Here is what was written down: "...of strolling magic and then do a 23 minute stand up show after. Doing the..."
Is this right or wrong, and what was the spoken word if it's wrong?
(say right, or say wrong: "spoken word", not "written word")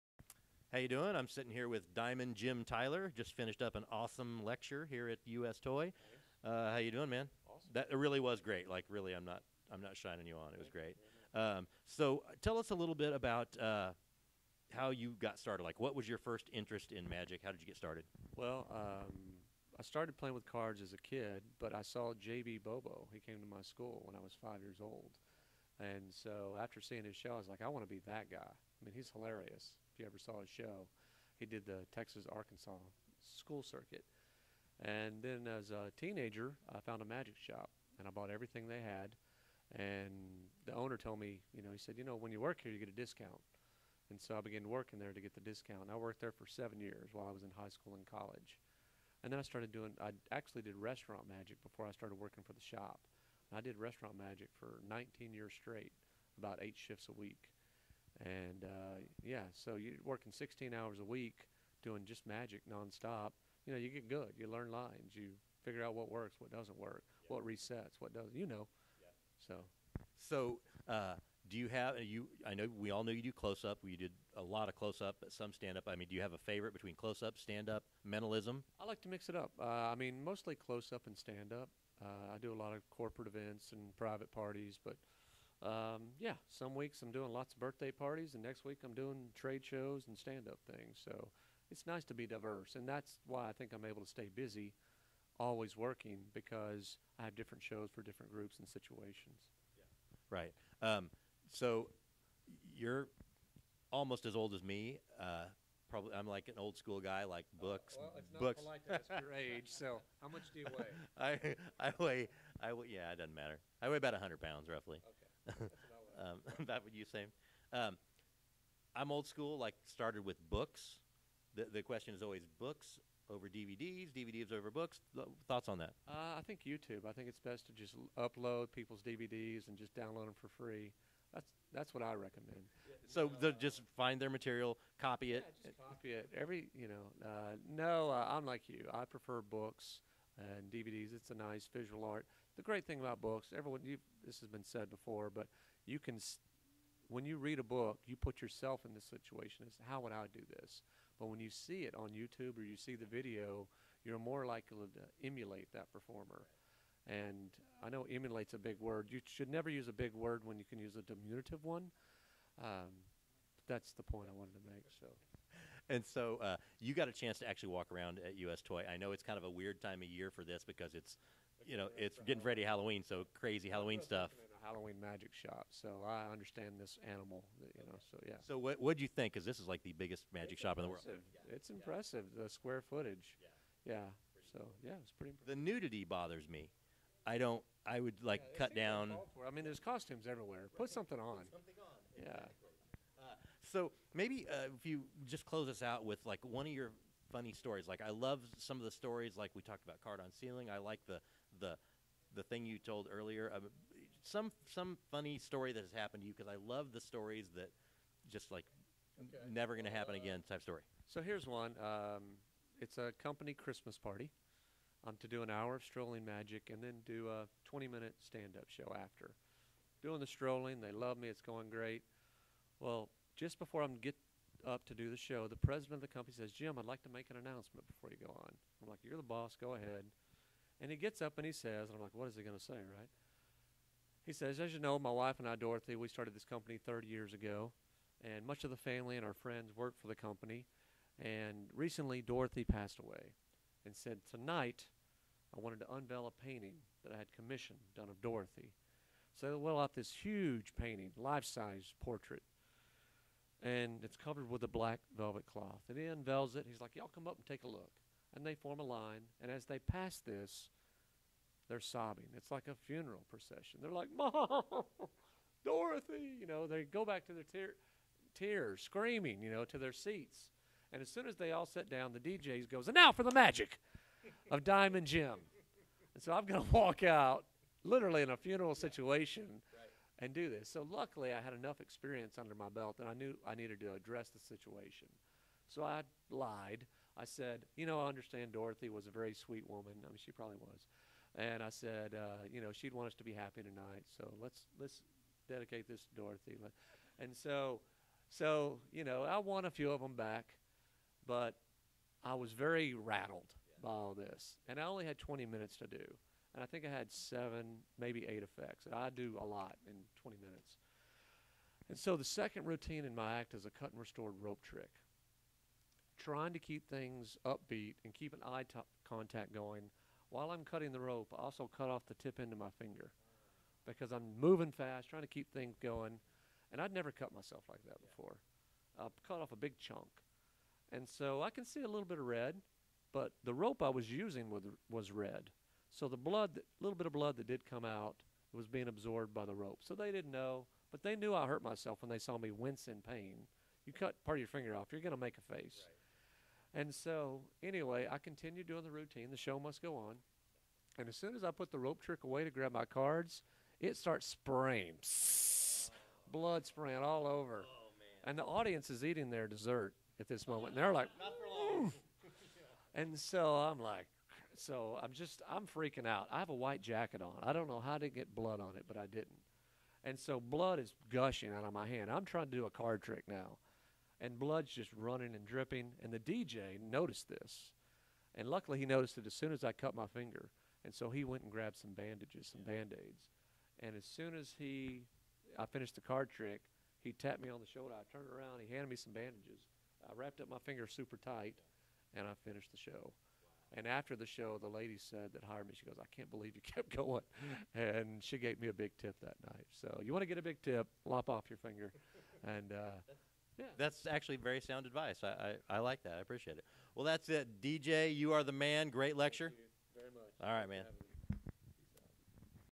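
wrong: "20", not "23".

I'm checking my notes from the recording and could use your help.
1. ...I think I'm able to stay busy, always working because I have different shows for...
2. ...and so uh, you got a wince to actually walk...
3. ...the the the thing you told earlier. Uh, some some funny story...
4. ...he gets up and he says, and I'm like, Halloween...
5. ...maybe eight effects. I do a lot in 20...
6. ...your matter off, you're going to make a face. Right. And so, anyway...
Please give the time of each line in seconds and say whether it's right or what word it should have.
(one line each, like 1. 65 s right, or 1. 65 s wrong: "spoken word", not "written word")
1. 93 s right
2. 165 s wrong: "chance", not "wince"
3. 201 s right
4. 230 s wrong: "What", not "Halloween"
5. 307 s right
6. 344 s wrong: "finger", not "matter".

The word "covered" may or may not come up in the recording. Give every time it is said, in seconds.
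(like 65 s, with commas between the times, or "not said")
254 s.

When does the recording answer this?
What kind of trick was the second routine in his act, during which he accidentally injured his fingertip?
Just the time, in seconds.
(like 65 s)
313 s.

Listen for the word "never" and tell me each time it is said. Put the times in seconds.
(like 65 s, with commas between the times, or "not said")
159 s, 209 s, 326 s.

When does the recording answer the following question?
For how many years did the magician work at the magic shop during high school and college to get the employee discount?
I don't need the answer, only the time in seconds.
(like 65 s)
46 s.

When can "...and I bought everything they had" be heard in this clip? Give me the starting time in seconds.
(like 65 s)
37 s.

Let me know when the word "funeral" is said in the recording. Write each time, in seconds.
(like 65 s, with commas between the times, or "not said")
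262 s, 278 s.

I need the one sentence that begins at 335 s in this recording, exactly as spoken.
So the blood, a little bit of blood that did come out, was being absorbed by the rope.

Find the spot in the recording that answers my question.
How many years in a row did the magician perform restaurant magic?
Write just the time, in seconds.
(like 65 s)
54 s.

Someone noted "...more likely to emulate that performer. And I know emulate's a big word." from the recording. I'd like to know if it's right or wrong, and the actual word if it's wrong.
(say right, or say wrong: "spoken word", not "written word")
right.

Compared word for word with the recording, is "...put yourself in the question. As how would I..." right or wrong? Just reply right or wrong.
wrong.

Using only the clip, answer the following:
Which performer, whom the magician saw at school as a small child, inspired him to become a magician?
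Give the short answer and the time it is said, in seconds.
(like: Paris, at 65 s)
J.B. Bobo, at 22 s.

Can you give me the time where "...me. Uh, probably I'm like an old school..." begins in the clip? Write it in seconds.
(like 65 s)
104 s.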